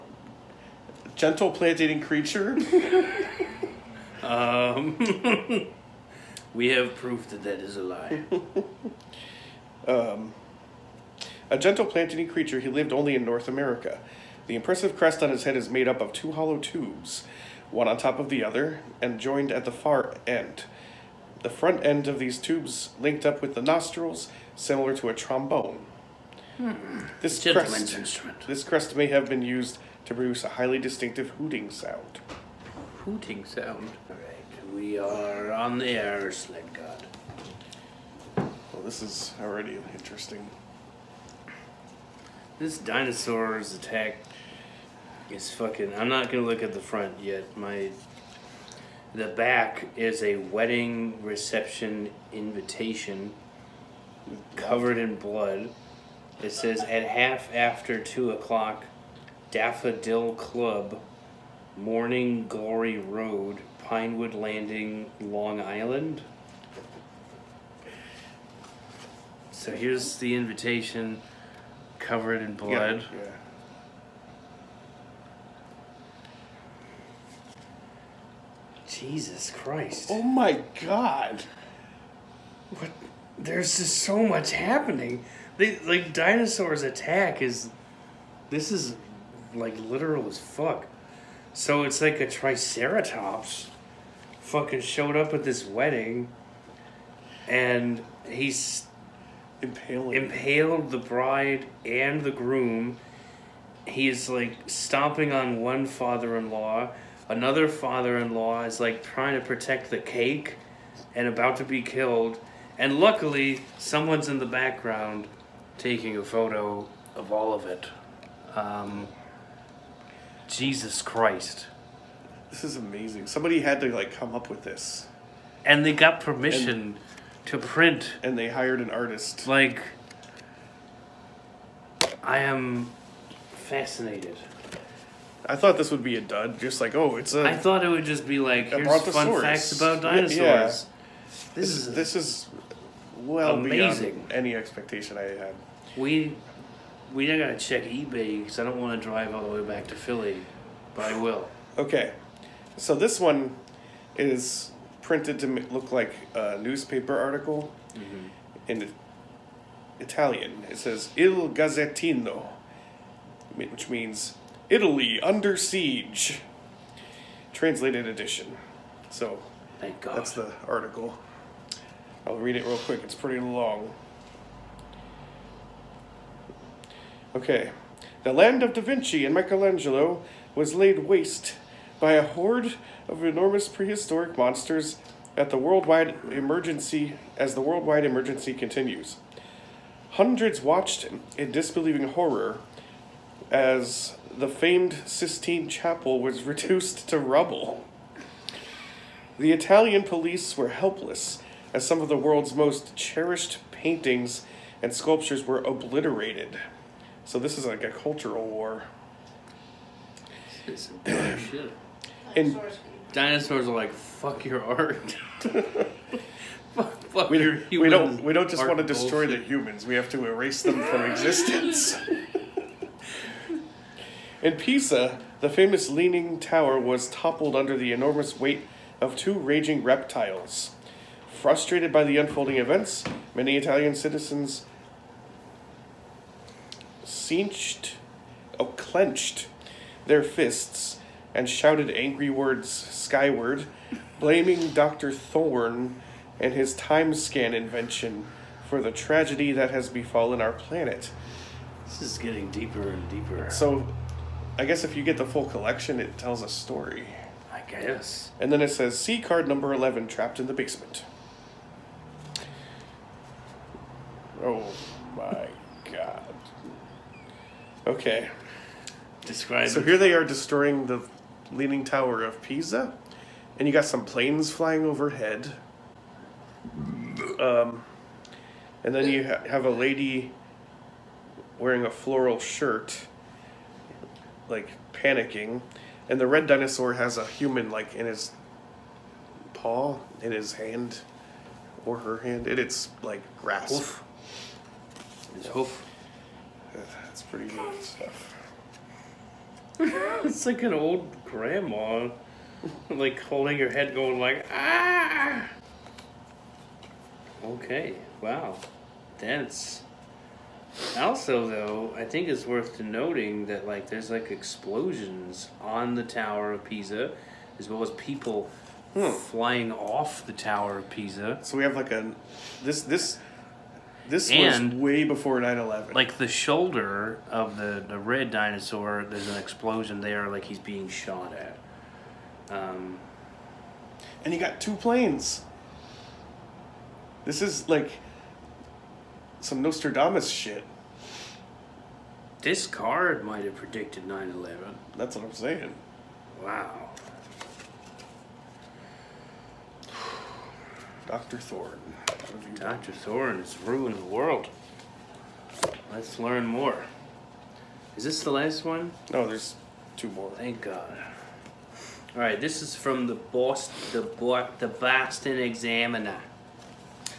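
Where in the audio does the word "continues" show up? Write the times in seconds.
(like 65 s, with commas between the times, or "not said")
188 s.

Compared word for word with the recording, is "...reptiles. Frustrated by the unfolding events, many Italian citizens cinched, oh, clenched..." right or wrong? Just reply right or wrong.
right.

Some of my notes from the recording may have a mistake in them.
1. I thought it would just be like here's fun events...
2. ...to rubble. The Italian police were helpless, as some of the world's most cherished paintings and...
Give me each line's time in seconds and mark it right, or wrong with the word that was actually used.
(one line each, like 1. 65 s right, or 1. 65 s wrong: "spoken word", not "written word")
1. 137 s wrong: "facts", not "events"
2. 197 s right.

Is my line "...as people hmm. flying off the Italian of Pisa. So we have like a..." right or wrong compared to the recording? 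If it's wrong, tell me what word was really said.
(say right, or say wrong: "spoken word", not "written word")
wrong: "Tower", not "Italian".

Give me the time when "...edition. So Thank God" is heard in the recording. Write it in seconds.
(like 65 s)
168 s.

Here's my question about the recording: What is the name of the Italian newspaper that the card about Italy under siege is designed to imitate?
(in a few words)
Il Gazzettino.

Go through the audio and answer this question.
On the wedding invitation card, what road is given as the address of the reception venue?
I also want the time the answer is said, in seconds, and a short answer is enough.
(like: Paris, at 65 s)
Morning Glory Road, at 61 s.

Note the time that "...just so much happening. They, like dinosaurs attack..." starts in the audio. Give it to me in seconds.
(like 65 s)
83 s.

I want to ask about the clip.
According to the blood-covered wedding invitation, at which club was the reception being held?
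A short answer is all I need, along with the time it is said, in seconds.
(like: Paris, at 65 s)
Daffodil Club, at 59 s.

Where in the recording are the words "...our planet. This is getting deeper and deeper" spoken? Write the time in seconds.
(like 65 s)
250 s.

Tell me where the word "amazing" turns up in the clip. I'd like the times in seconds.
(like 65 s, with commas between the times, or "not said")
122 s, 143 s.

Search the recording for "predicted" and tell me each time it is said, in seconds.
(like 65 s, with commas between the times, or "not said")
343 s.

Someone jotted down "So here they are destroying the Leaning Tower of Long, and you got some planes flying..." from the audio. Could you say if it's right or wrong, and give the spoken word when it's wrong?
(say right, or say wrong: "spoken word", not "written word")
wrong: "Pisa", not "Long".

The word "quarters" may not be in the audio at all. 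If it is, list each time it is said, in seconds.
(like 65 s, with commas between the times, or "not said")
not said.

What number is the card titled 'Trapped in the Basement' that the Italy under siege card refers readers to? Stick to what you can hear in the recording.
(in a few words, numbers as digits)
11.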